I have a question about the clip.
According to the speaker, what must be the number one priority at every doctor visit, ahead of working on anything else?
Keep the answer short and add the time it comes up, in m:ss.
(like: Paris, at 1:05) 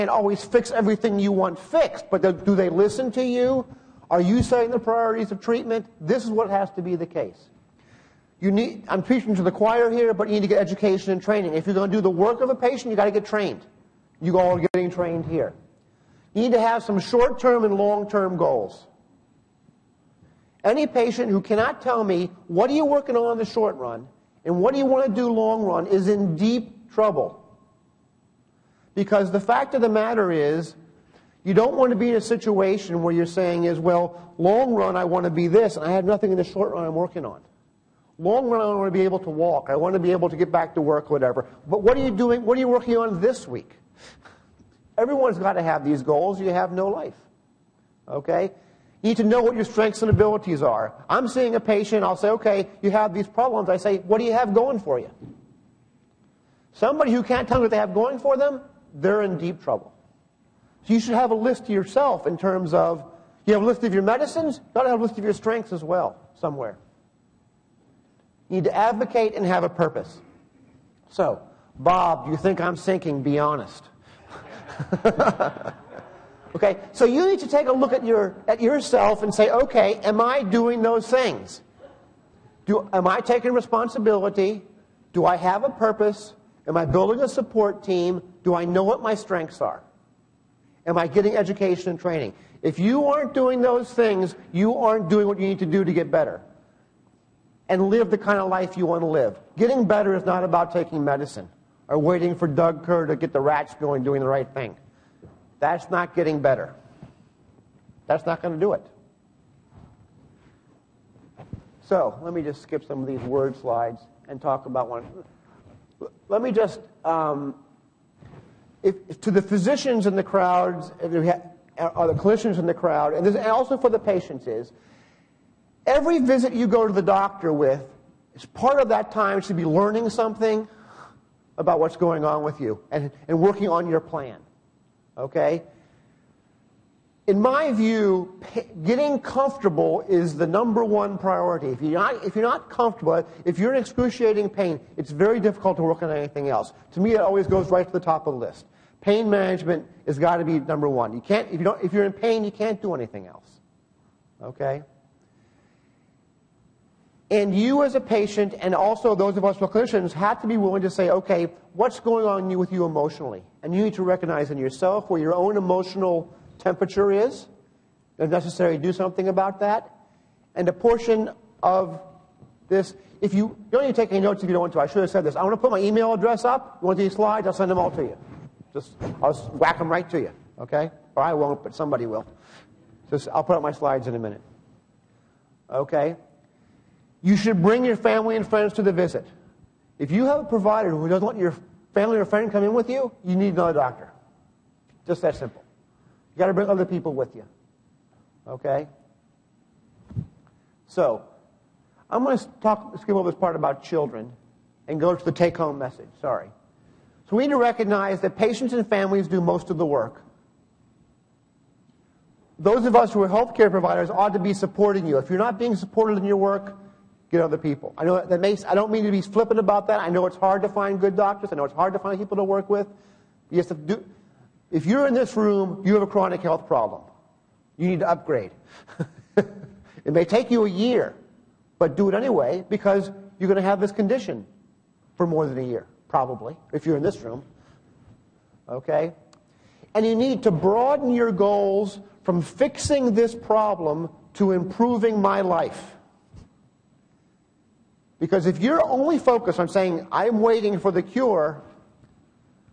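Pain management, at 2:29.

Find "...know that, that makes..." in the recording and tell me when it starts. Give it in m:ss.
3:38.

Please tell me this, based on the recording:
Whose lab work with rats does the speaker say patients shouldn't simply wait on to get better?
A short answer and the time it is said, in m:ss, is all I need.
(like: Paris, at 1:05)
Doug Kerr, at 1:42.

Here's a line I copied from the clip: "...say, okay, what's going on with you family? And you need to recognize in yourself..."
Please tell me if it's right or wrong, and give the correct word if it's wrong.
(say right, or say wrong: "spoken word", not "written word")
wrong: "emotionally", not "family".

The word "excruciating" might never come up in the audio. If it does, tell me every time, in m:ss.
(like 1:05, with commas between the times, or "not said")
2:23.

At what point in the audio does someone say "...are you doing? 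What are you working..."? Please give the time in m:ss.
0:41.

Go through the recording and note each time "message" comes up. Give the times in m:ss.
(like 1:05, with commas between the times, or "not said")
3:25.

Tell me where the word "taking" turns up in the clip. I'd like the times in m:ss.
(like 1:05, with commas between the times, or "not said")
1:23, 1:40.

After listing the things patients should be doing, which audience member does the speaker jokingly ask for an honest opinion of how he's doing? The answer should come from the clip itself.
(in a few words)
Bob.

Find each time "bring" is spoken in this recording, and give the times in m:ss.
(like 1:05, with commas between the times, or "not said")
3:07, 3:16.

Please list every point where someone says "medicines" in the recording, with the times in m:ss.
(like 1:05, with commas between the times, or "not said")
1:04, 1:41.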